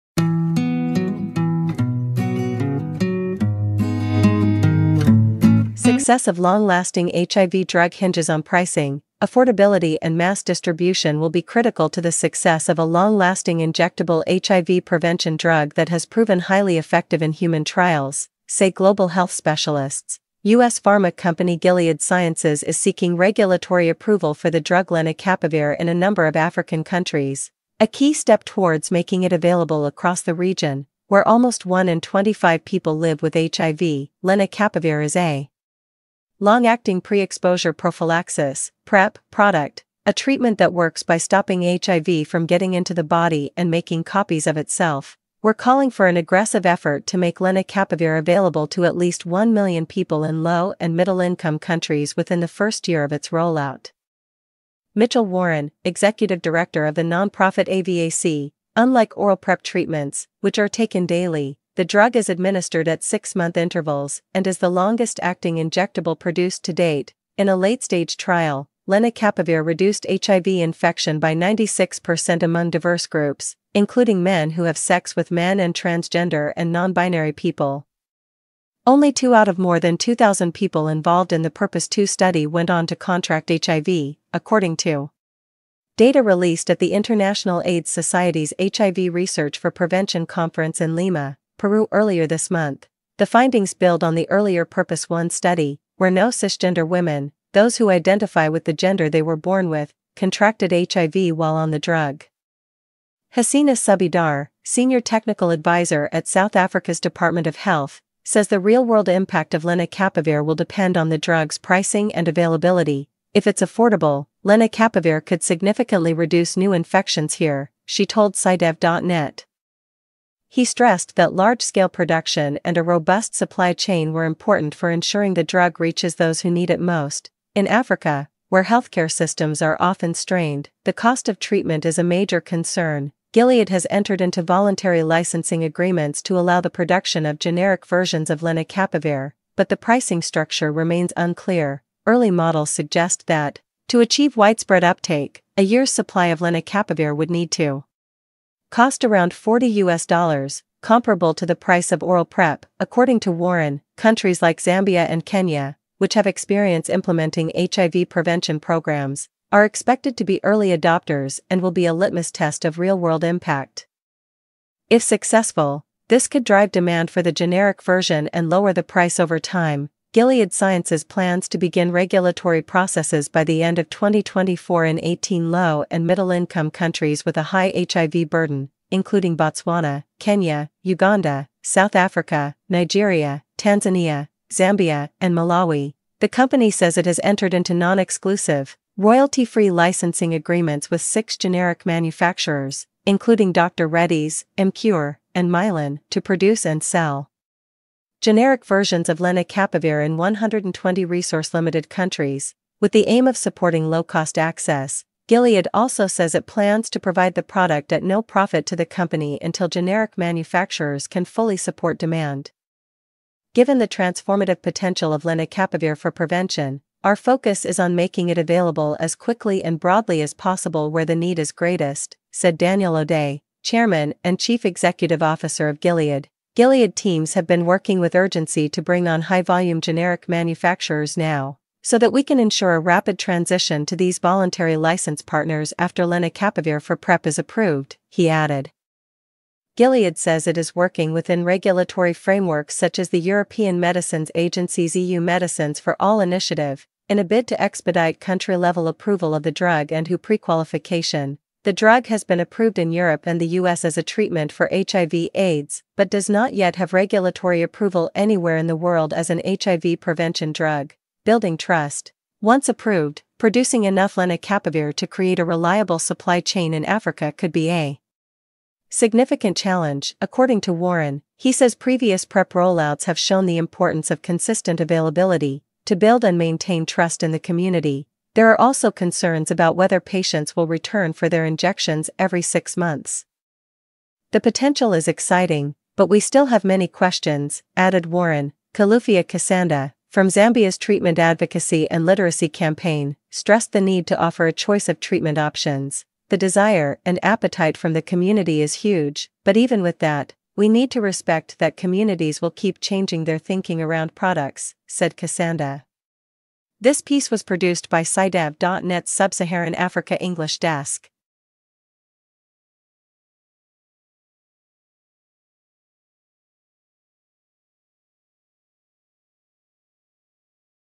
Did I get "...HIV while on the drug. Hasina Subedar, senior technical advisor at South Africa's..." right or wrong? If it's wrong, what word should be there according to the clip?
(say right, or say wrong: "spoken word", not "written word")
right.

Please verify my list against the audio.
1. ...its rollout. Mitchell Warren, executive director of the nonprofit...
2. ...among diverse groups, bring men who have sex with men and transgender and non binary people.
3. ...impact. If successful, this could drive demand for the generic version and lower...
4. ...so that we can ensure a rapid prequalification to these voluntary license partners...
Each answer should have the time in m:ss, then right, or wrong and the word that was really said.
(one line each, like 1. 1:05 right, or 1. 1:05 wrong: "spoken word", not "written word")
1. 0:53 right
2. 1:12 wrong: "including", not "bring"
3. 2:43 right
4. 3:51 wrong: "transition", not "prequalification".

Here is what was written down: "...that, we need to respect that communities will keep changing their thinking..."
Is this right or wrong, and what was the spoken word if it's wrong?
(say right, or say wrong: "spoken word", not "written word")
right.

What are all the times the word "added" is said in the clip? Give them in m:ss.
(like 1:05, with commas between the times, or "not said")
3:58, 4:47.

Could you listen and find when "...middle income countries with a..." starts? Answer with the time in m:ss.
2:56.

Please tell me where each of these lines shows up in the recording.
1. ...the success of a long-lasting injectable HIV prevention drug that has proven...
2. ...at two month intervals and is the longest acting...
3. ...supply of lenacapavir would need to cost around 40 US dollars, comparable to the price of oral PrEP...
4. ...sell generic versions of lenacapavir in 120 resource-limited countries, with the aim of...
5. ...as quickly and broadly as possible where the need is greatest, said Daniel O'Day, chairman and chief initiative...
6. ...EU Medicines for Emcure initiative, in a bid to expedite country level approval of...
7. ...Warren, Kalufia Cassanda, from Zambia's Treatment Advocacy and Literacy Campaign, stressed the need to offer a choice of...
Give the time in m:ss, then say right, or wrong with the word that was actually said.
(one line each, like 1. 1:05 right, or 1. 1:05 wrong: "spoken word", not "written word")
1. 0:11 right
2. 1:02 wrong: "six", not "two"
3. 2:25 right
4. 3:16 right
5. 3:38 wrong: "executive", not "initiative"
6. 4:04 wrong: "All", not "Emcure"
7. 4:48 right.